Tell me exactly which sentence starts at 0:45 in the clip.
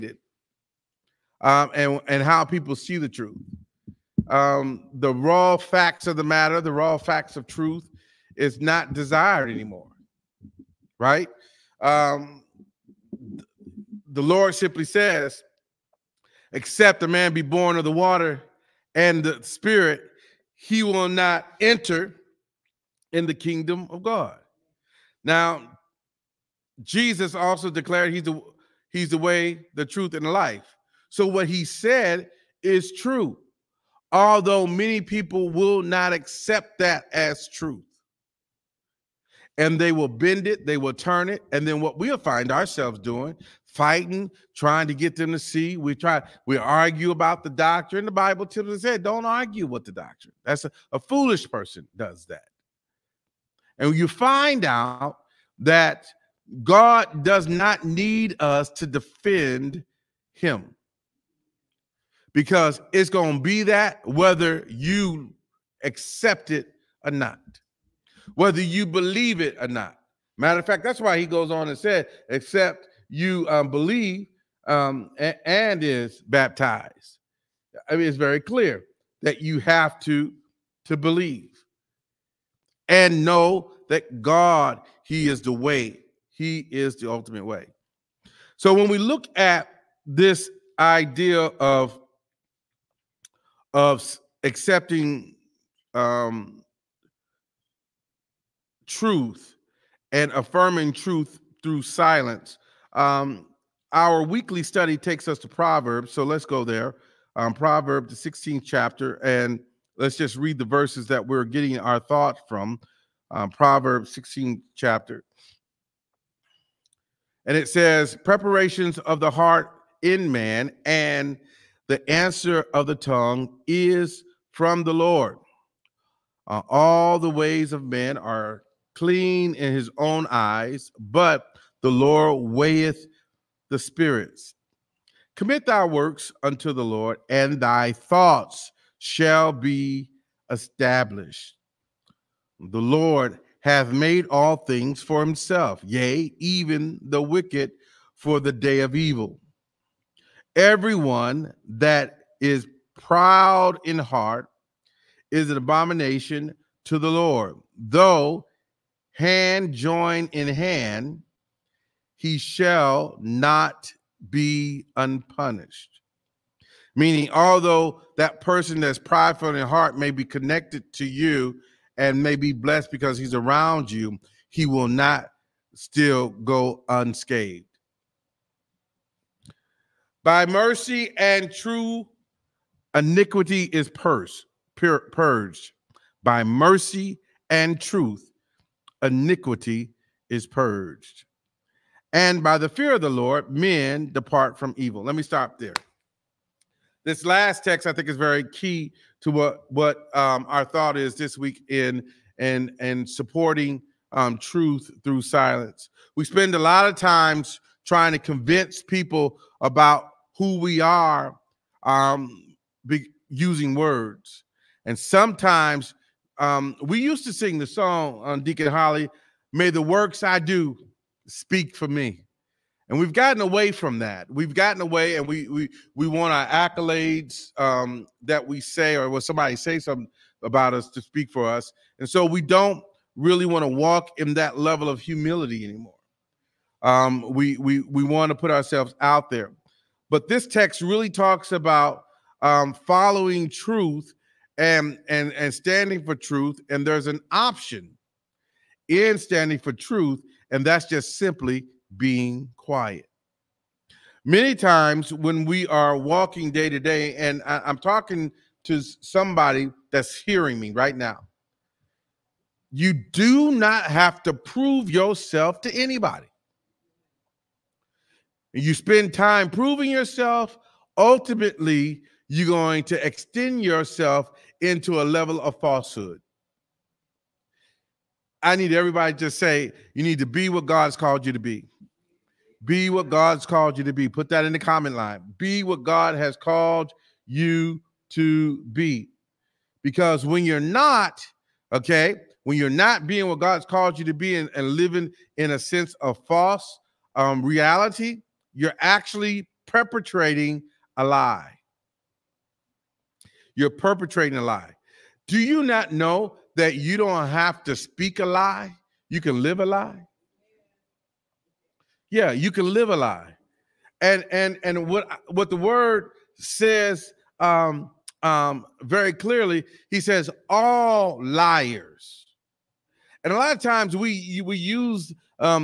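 We try, we argue about the doctrine.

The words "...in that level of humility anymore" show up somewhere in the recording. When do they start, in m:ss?
3:54.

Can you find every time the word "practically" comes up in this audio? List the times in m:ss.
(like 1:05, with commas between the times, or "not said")
not said.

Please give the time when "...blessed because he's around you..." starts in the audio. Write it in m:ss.
2:52.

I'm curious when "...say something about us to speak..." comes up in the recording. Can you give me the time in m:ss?
3:49.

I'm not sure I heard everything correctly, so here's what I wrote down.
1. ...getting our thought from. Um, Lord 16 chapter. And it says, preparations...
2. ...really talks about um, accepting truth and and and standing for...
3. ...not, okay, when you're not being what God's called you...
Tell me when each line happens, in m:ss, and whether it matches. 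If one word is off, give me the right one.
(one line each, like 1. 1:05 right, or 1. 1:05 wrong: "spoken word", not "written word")
1. 1:51 wrong: "Proverbs", not "Lord"
2. 4:00 wrong: "following", not "accepting"
3. 4:50 right.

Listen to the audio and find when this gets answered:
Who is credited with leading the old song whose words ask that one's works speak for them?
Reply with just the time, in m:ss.
3:38.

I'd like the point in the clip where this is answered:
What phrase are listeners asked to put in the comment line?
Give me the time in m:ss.
4:45.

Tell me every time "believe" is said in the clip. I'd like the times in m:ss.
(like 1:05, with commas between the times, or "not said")
1:08, 1:13, 1:20.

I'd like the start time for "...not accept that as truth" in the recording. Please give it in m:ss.
0:35.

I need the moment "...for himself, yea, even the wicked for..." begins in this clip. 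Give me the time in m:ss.
2:25.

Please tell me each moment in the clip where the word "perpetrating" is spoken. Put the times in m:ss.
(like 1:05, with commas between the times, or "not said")
4:59, 5:03.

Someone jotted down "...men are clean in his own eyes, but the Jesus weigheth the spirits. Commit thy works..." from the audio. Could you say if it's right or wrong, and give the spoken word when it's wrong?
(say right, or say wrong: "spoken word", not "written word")
wrong: "Lord", not "Jesus".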